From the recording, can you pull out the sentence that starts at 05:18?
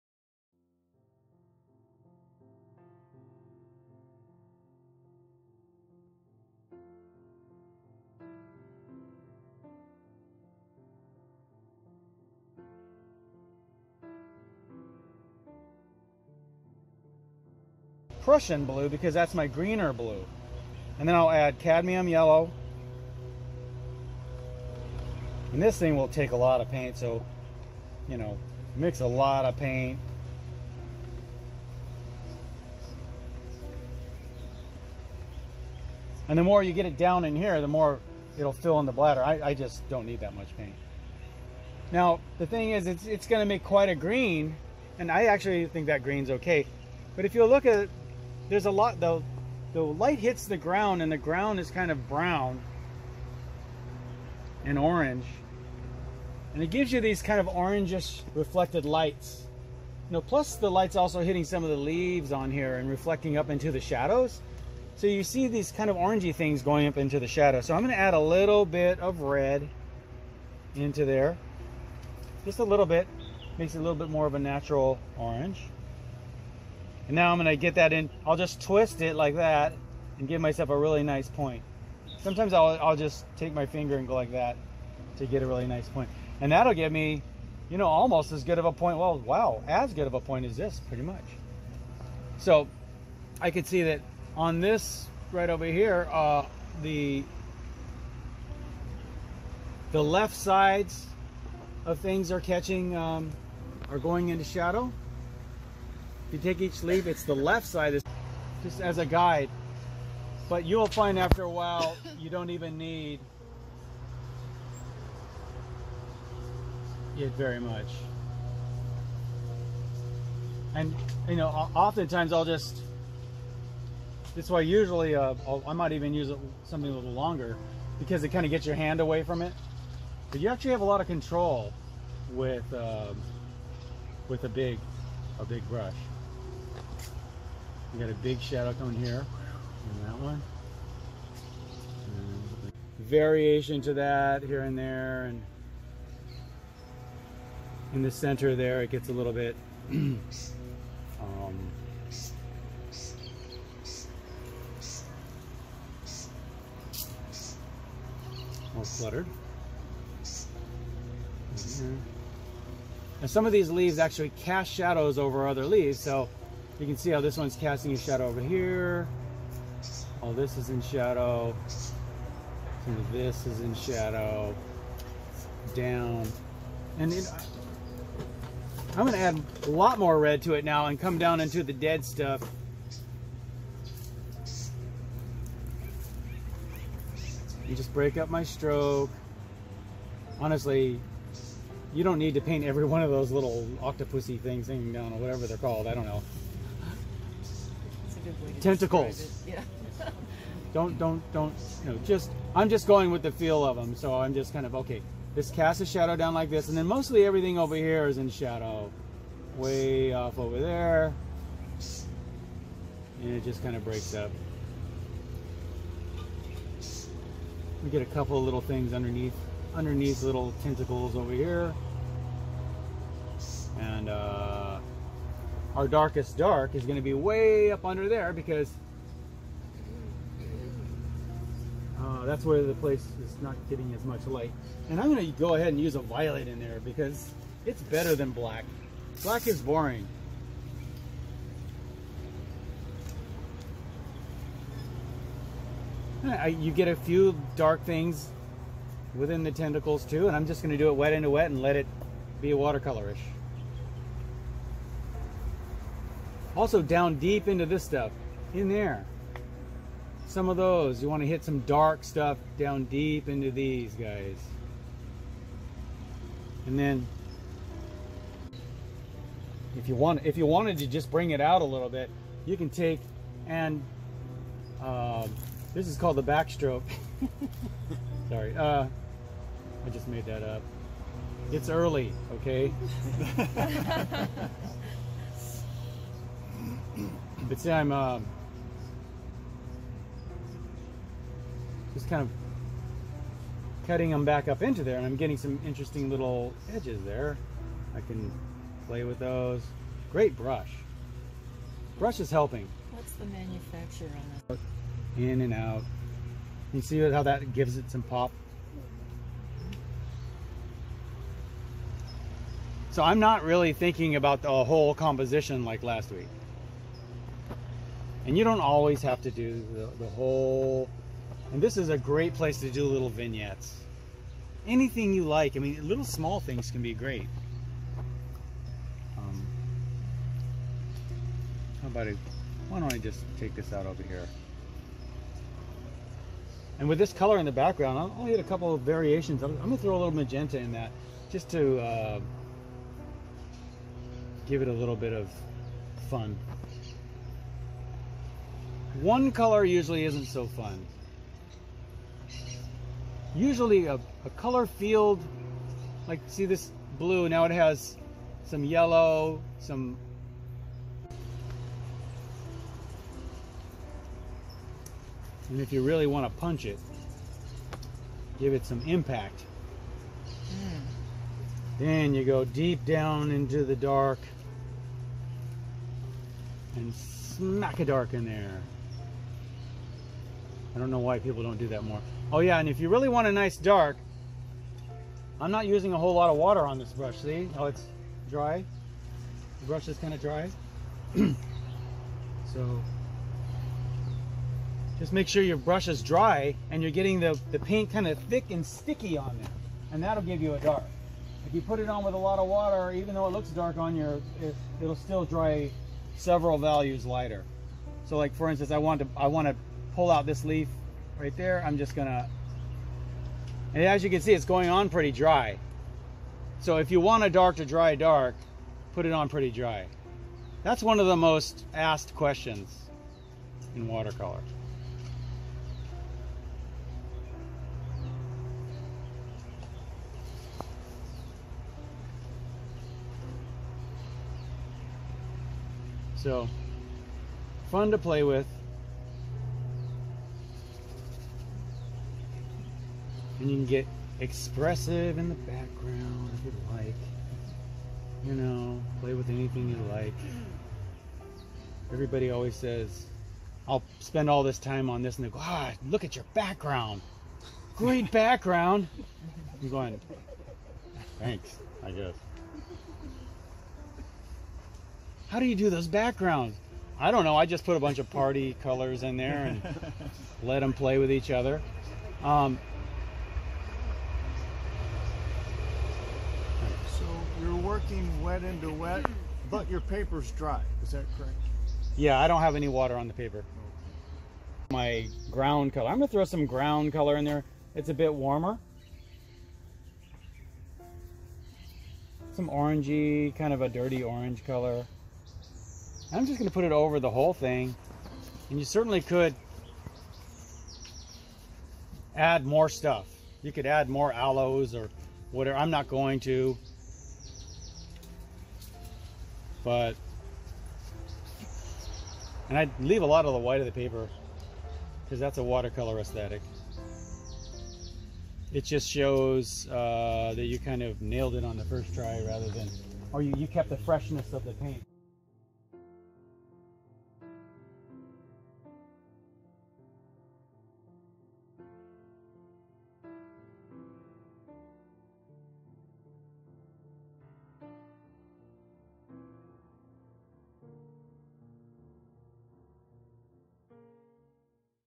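And you don't always have to do the, the whole.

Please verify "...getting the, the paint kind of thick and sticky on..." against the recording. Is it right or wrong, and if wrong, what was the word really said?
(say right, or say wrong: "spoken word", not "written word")
right.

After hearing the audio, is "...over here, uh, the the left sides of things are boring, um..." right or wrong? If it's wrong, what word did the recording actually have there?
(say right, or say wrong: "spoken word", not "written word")
wrong: "catching", not "boring".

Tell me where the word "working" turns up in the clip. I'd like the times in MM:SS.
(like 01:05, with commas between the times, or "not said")
07:57.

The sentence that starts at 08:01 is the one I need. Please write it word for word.
Yeah, I don't have any water on the paper.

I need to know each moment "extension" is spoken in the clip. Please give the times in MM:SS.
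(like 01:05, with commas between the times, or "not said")
not said.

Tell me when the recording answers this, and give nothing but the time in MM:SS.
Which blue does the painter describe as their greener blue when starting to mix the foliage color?
00:18.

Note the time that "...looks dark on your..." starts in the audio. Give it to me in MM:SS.
06:43.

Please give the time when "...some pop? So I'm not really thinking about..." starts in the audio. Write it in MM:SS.
05:07.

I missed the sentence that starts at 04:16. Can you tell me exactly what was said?
Also down deep into this stuff, in there.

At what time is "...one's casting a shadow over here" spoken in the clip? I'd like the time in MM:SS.
02:47.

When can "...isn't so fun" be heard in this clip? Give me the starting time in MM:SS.
05:50.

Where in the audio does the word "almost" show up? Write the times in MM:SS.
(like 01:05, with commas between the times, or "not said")
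01:27.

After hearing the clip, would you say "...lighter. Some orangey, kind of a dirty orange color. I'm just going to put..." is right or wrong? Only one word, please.
wrong.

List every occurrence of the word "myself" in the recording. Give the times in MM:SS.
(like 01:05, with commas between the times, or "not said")
01:20.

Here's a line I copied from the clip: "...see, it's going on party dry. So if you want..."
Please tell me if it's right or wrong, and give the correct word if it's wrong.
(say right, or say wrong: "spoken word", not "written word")
wrong: "pretty", not "party".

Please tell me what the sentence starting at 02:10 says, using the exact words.
But you actually have a lot of control with, um, with a big, a big brush.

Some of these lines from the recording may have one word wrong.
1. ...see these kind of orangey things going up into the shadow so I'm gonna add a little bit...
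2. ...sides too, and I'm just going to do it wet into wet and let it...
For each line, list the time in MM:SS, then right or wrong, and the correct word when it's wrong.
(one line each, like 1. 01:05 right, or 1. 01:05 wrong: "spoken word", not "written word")
1. 01:05 right
2. 04:09 wrong: "tentacles", not "sides".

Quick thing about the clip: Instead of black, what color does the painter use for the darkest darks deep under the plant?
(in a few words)
violet.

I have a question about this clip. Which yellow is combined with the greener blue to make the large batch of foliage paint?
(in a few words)
cadmium yellow.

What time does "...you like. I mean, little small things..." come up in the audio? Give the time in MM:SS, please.
05:25.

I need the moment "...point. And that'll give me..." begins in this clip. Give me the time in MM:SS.
01:25.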